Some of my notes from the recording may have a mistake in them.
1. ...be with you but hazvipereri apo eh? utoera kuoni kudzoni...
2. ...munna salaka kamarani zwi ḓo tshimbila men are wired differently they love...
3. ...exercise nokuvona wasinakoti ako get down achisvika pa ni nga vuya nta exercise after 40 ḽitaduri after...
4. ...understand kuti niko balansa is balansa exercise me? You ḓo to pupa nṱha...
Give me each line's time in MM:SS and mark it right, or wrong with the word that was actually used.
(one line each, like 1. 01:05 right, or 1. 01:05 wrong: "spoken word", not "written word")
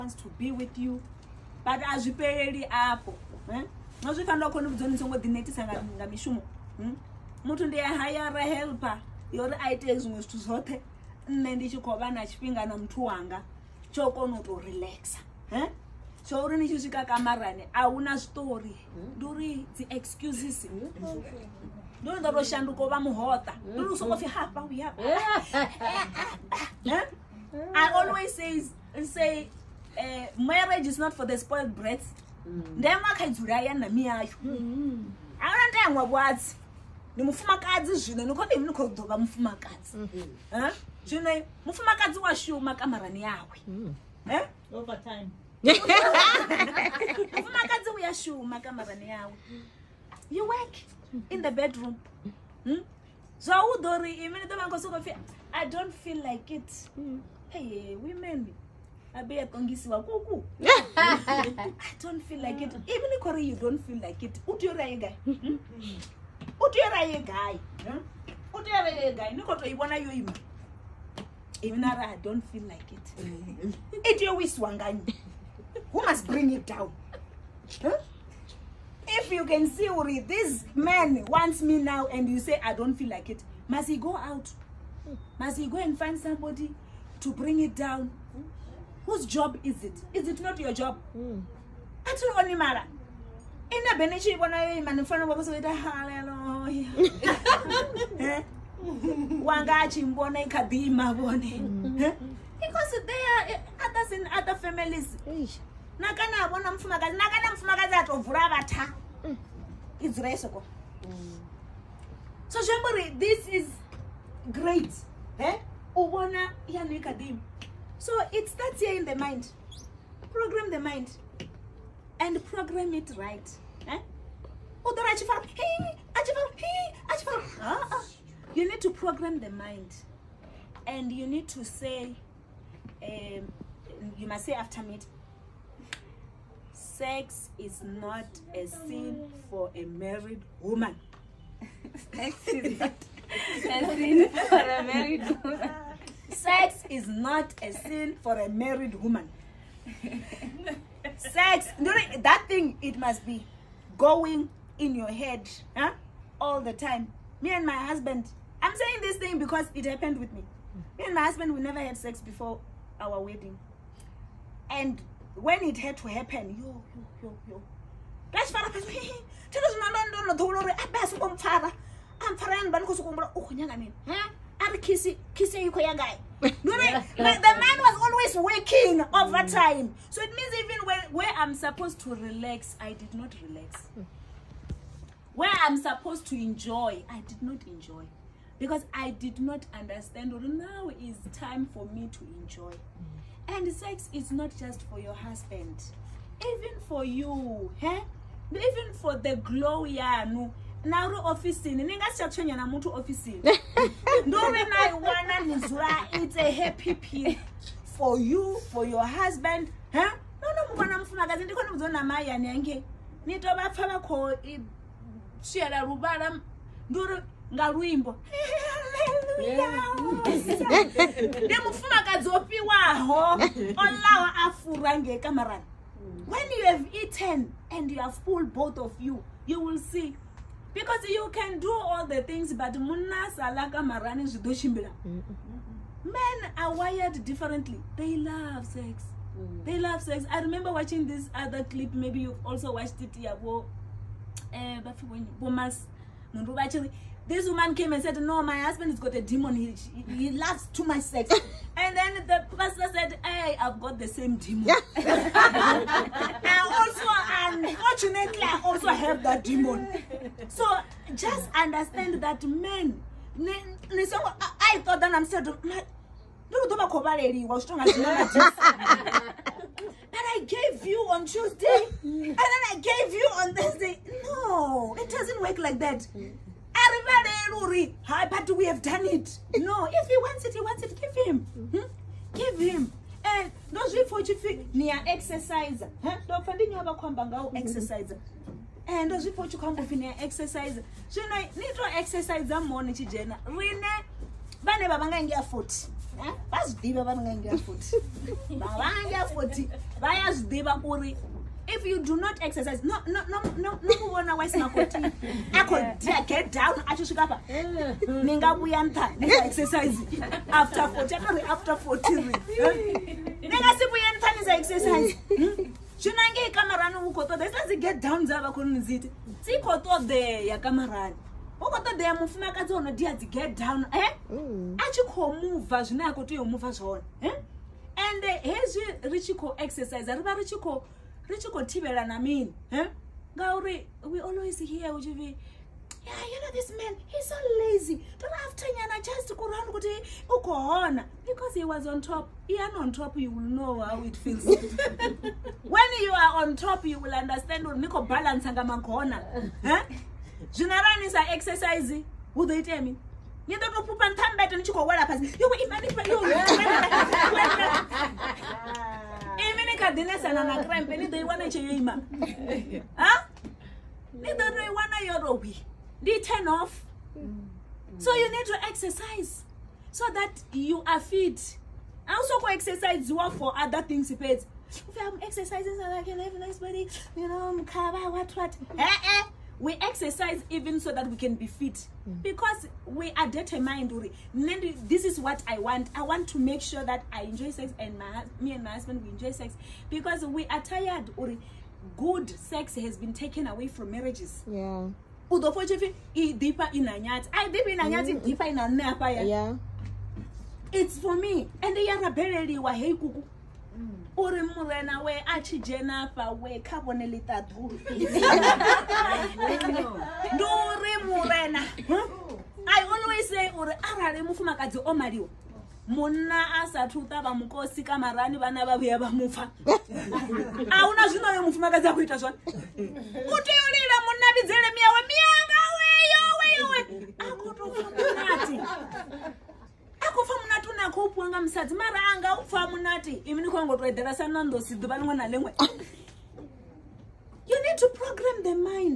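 1. 00:00 wrong: "nozvifanira", not "utoera"
2. 03:52 wrong: "marani", not "kamarani"
3. 05:02 wrong: "akari", not "ḽitaduri"
4. 05:47 wrong: "zvinoranisa", not "balansa".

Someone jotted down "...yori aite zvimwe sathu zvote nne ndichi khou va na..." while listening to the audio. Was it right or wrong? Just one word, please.
wrong.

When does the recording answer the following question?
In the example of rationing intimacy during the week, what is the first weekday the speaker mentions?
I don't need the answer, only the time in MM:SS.
04:31.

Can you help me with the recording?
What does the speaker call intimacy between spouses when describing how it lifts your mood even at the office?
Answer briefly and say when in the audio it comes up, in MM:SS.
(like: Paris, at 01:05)
a happy pill, at 03:26.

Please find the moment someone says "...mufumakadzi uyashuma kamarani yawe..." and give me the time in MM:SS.
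00:47.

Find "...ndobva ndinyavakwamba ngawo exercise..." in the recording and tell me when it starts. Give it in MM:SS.
04:46.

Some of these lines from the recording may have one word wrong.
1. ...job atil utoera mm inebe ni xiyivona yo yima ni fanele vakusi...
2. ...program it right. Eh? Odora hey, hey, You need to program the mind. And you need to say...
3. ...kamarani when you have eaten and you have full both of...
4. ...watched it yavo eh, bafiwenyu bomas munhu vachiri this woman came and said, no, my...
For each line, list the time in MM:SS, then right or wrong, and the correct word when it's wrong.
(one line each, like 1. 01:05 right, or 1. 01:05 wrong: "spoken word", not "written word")
1. 01:30 wrong: "onimara", not "utoera"
2. 02:02 right
3. 03:45 right
4. 04:02 right.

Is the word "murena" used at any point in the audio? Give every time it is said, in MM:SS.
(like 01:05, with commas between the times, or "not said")
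06:44, 06:51.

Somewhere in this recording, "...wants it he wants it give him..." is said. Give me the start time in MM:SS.
04:40.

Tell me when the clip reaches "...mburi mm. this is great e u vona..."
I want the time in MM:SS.
01:52.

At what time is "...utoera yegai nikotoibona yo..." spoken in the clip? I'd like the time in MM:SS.
01:08.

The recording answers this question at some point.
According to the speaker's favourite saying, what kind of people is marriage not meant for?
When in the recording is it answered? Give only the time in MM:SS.
00:31.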